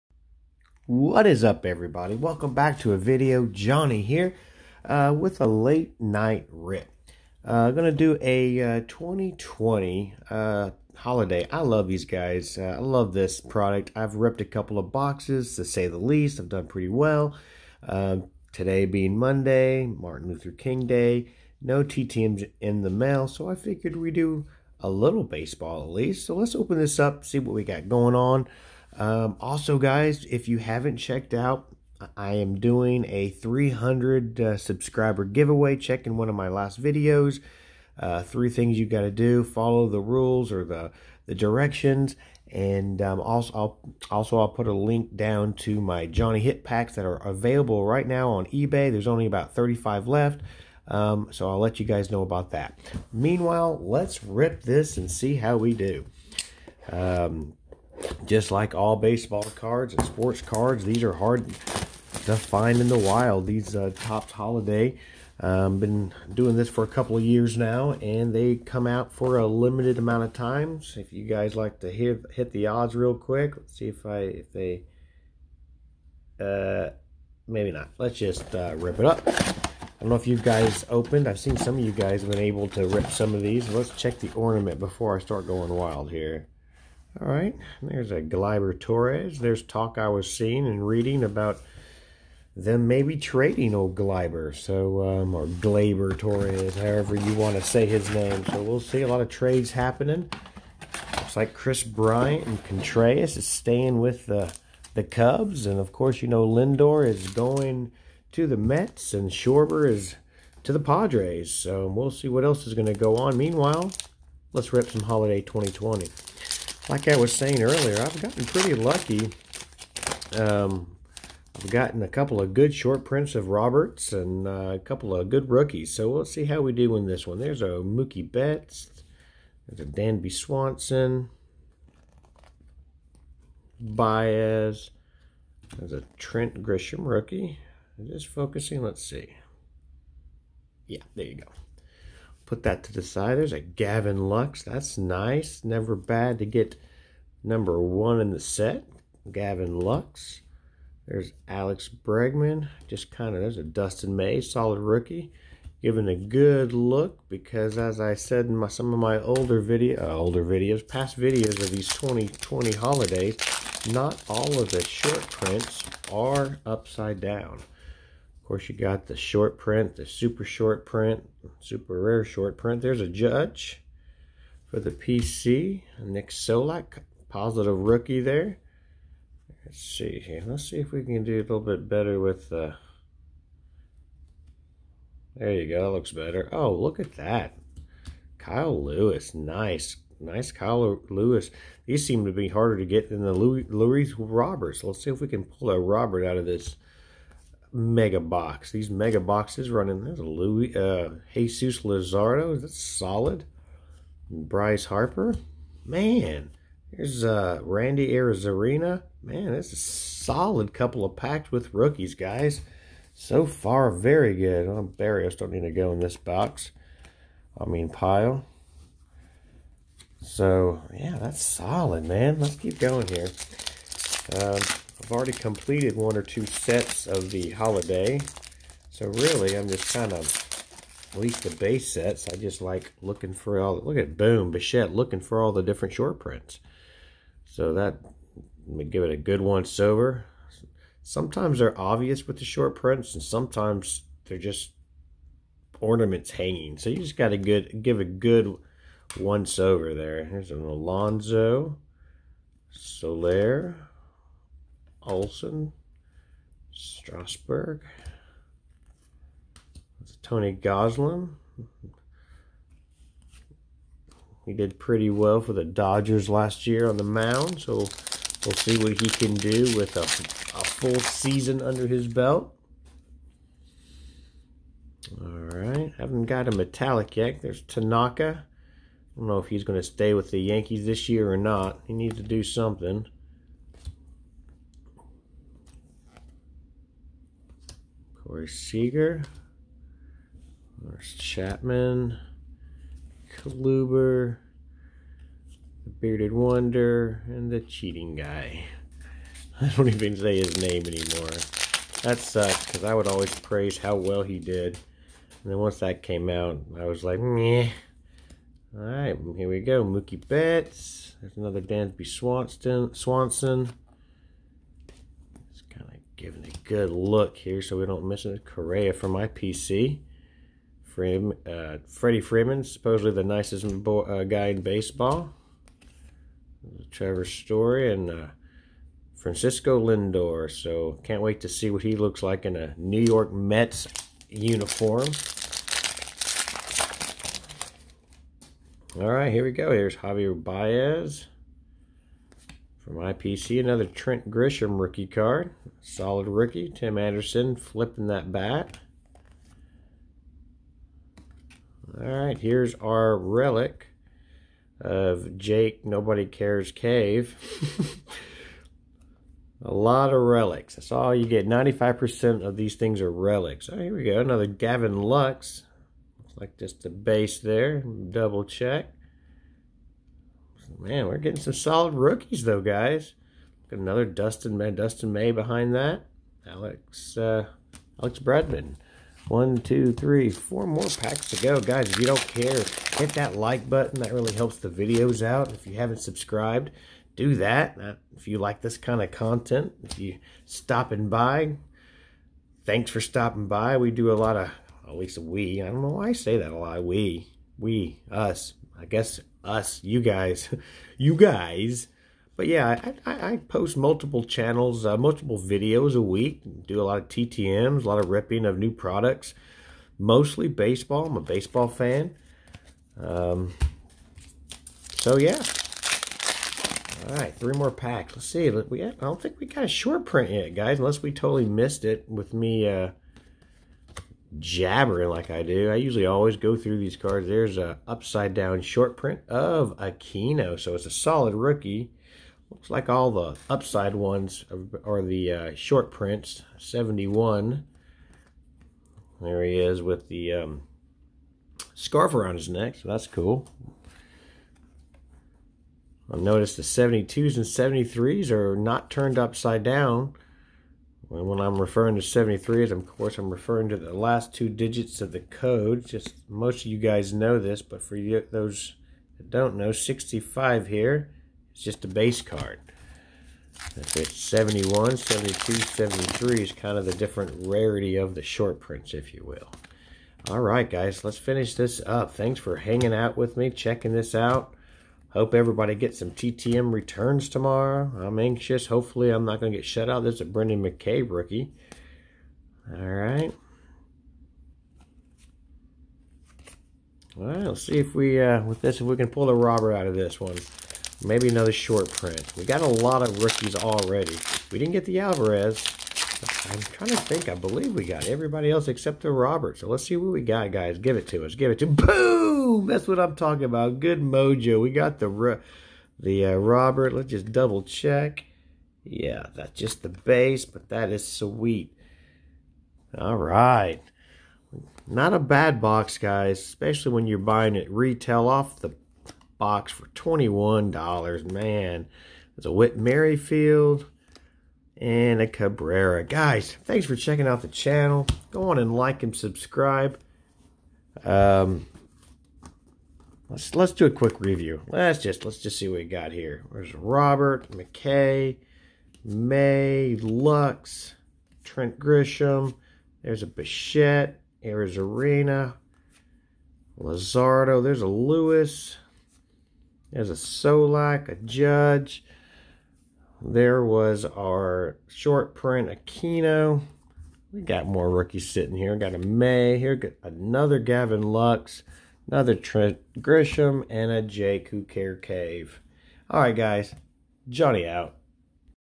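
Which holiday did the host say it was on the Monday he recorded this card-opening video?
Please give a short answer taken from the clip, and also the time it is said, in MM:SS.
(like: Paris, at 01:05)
Martin Luther King Day, at 00:19.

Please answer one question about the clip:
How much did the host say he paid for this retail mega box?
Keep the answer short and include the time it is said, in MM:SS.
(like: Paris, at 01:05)
$21, at 08:39.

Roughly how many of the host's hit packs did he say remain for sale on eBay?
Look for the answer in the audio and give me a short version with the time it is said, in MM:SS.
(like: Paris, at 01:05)
35, at 00:49.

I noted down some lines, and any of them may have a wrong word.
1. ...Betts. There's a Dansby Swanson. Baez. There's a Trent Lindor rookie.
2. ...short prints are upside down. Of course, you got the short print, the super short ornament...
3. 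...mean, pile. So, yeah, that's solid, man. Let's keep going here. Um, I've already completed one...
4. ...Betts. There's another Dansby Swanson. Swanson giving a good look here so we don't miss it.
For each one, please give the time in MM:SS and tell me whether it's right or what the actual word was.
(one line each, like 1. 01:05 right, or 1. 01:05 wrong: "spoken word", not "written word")
1. 02:08 wrong: "Grisham", not "Lindor"
2. 02:44 wrong: "print", not "ornament"
3. 03:37 right
4. 05:10 right.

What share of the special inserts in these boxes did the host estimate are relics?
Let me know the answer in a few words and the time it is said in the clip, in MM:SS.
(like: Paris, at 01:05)
95%, at 06:01.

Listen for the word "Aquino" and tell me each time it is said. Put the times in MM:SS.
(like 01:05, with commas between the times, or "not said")
07:09, 09:15.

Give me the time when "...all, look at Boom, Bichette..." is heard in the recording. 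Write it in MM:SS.
03:53.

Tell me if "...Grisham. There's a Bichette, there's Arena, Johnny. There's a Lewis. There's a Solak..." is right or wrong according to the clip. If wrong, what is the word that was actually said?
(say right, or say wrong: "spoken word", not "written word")
wrong: "Luzardo", not "Johnny".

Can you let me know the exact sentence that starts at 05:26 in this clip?
Trevor Story and uh, Francisco Lindor.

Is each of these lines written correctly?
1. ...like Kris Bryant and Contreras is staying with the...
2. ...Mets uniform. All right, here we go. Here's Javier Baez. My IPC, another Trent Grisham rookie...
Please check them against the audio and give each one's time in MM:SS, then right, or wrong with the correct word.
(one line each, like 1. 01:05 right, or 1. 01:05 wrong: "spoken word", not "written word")
1. 01:41 right
2. 05:33 right.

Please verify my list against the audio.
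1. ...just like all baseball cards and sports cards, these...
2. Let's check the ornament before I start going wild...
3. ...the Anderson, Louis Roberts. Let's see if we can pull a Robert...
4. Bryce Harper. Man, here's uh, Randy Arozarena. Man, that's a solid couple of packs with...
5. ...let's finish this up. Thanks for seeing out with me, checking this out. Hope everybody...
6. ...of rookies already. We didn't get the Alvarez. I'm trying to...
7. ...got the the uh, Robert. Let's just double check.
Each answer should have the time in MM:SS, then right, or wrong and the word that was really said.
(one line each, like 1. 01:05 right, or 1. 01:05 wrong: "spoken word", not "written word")
1. 00:58 right
2. 01:23 right
3. 03:13 wrong: "Louis", not "Anderson"
4. 03:24 right
5. 07:51 wrong: "hanging", not "seeing"
6. 08:13 right
7. 08:24 right.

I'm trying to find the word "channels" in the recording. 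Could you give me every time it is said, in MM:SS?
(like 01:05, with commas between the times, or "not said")
06:44, 08:47.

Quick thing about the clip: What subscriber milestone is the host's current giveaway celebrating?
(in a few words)
300.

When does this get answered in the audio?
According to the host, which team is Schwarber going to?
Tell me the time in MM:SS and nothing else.
01:50.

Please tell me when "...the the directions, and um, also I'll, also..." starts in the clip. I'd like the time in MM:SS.
00:40.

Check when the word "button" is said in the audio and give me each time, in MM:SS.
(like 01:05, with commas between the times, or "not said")
06:23.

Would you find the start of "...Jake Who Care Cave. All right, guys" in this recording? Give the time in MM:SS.
09:24.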